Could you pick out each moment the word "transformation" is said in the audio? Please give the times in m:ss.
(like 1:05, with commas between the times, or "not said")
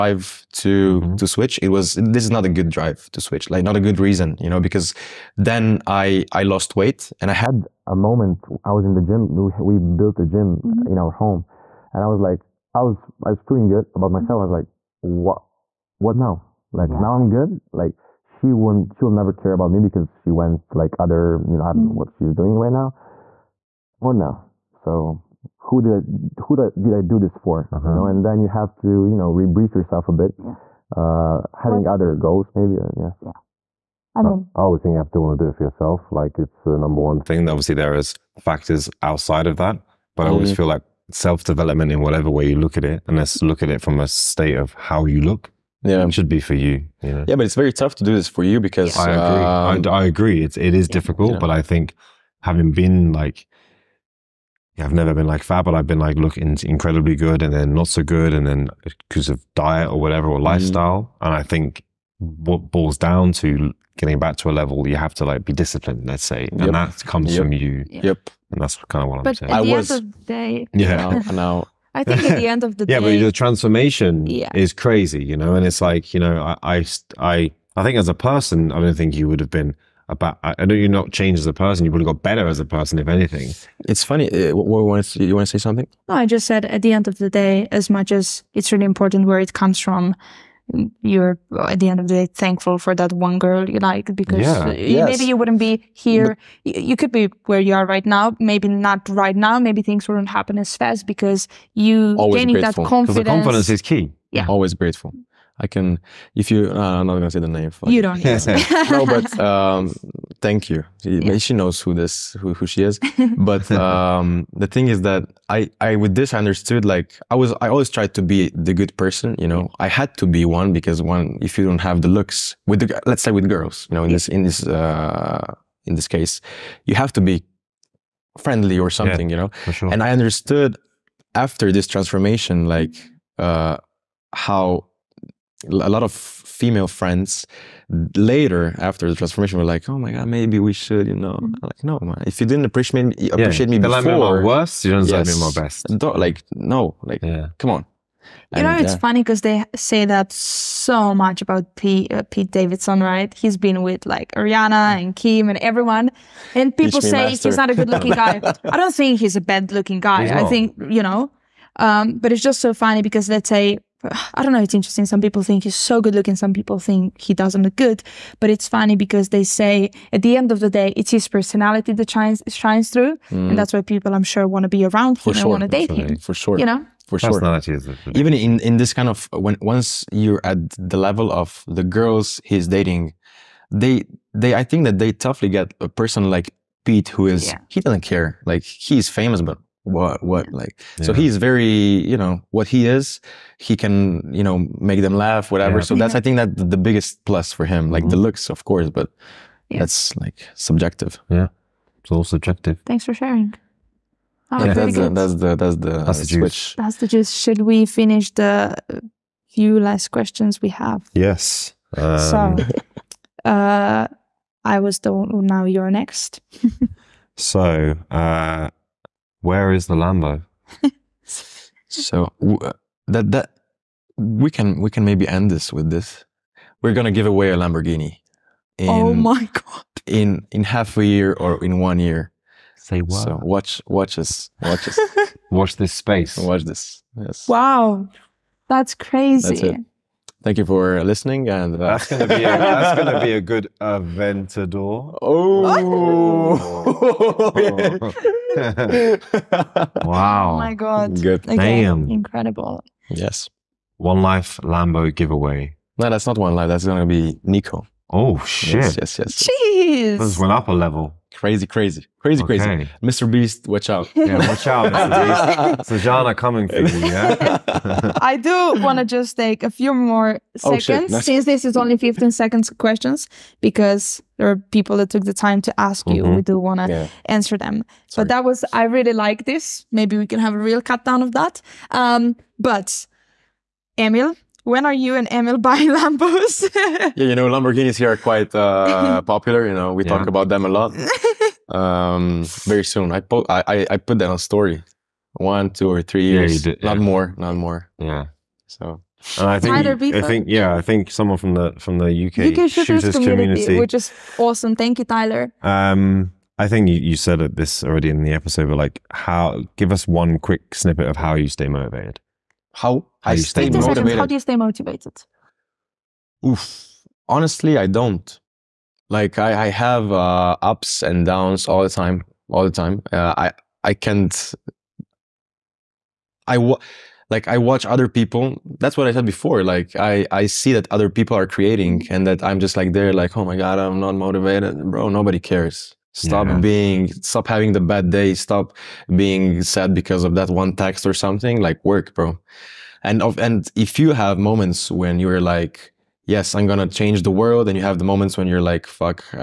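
1:13, 2:11, 2:19.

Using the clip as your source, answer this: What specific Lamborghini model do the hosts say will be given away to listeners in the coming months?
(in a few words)
Aventador.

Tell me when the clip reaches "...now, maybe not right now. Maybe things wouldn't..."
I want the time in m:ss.
1:38.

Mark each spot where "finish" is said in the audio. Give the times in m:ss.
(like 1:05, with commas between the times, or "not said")
3:27.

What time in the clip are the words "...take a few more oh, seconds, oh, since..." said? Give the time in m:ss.
4:29.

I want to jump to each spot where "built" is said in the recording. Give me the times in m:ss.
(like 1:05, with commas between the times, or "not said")
0:09.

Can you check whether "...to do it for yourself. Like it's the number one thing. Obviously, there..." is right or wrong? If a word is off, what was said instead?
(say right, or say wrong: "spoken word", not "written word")
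right.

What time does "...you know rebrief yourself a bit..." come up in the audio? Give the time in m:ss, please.
0:29.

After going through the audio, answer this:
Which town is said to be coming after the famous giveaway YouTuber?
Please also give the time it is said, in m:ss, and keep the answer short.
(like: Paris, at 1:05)
Sežana, at 4:25.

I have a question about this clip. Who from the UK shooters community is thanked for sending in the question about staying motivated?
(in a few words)
Tyler.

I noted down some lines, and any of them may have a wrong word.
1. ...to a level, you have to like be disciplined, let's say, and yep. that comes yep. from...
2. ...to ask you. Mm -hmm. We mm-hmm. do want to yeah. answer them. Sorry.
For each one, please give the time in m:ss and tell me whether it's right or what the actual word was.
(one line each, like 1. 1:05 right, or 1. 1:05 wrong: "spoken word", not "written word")
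1. 1:04 right
2. 4:35 right.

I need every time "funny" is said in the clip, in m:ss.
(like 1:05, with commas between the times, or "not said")
1:24, 2:28, 2:42, 2:48.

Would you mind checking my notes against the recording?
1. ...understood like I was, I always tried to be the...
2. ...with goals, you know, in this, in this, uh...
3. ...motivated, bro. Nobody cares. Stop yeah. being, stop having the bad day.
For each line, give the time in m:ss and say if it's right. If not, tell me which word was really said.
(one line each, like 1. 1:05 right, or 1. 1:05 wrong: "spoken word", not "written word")
1. 1:56 right
2. 2:03 wrong: "girls", not "goals"
3. 5:34 right.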